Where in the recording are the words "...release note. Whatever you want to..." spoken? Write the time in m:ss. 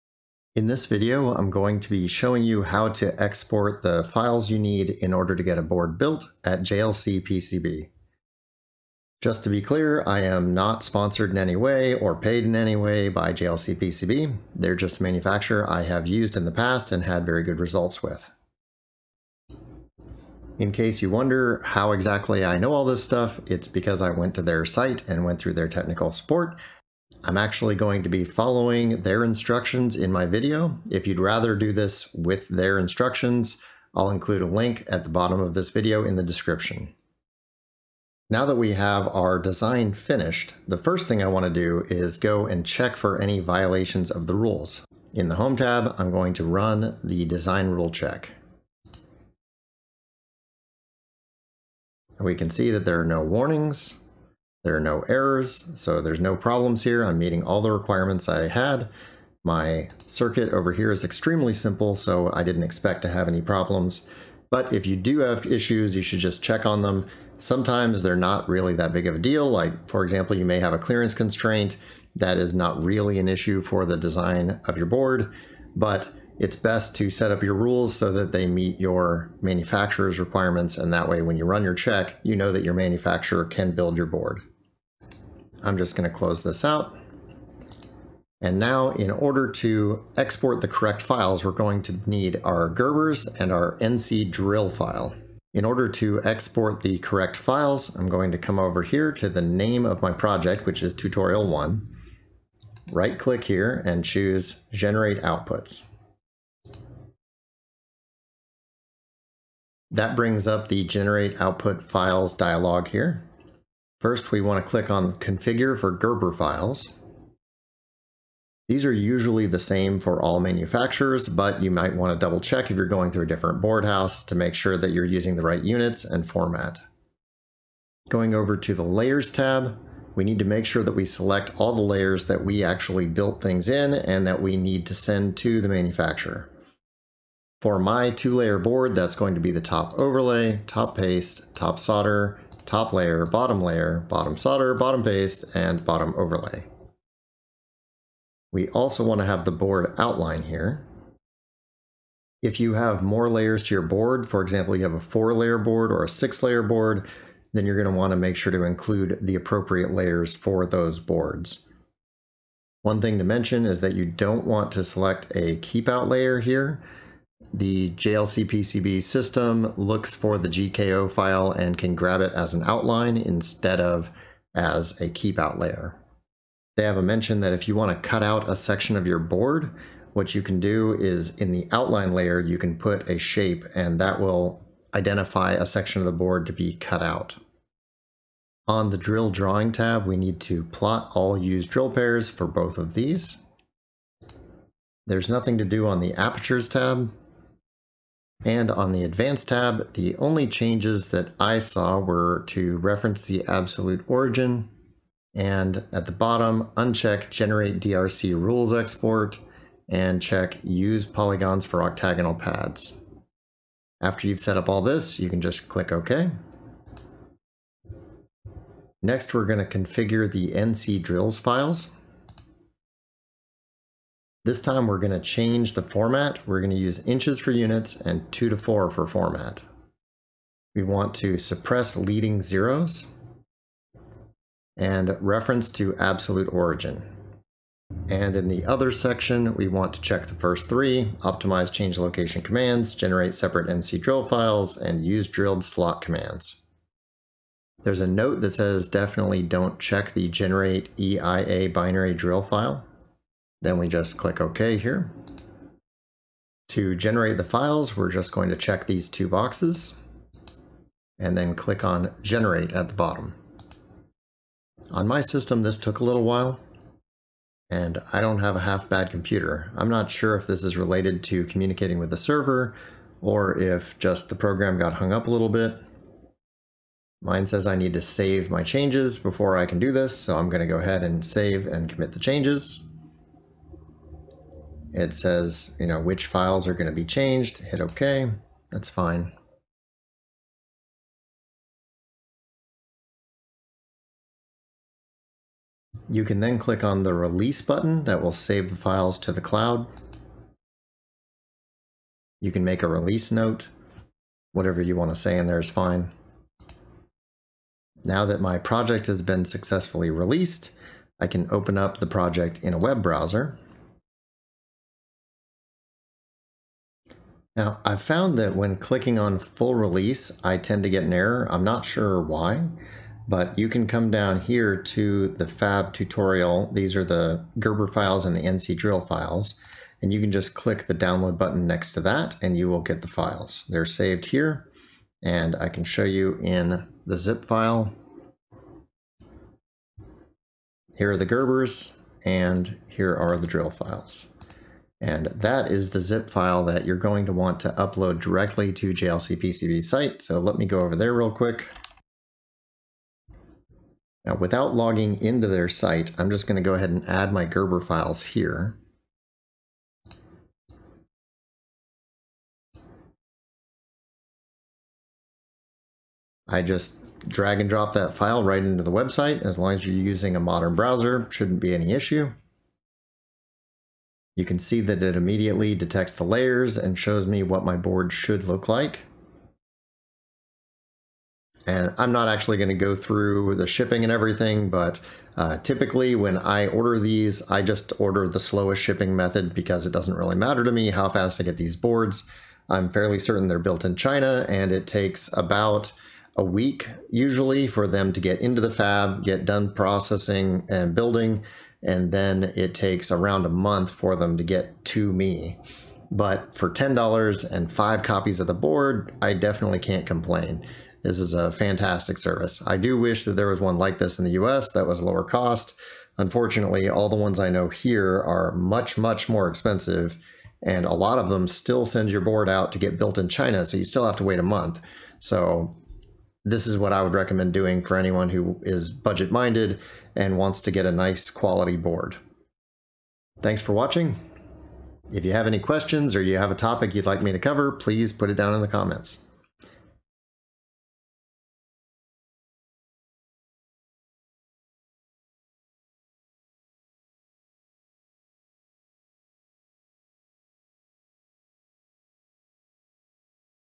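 5:02.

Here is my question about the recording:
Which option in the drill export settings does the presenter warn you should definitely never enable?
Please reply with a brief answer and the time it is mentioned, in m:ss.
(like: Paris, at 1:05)
generate EIA binary drill file, at 4:10.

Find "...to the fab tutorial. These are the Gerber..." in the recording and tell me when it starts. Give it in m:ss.
5:24.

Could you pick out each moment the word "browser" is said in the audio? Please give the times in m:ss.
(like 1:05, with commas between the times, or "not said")
5:13, 6:10.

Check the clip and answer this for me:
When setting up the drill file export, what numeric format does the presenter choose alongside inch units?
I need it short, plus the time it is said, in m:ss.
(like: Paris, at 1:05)
2 to 4, at 3:48.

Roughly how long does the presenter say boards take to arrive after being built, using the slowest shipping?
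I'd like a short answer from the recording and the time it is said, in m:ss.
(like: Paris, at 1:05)
around a month, at 6:43.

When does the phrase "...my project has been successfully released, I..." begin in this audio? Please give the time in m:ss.
5:08.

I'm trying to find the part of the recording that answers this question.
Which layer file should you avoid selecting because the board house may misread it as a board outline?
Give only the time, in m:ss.
2:50.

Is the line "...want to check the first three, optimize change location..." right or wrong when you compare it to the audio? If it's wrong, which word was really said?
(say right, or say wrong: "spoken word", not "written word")
right.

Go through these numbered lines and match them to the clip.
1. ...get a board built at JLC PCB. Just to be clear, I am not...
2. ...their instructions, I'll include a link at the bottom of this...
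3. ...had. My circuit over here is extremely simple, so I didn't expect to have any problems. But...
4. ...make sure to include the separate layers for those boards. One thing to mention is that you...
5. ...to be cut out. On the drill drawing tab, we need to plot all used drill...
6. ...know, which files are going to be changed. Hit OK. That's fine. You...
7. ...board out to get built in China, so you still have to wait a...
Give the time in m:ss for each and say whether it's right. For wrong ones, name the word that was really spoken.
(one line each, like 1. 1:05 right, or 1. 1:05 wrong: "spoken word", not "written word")
1. 0:05 right
2. 0:32 right
3. 0:58 right
4. 2:38 wrong: "appropriate", not "separate"
5. 3:06 right
6. 4:45 right
7. 7:02 right.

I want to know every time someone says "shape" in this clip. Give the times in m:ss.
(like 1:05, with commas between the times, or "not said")
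3:03.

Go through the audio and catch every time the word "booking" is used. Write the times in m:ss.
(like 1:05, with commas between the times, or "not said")
not said.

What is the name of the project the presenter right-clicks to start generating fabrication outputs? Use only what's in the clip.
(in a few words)
tutorial one.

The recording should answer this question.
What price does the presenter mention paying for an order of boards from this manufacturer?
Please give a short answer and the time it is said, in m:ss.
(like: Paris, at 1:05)
$10, at 6:46.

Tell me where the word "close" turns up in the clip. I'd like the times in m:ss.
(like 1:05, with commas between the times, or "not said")
1:26.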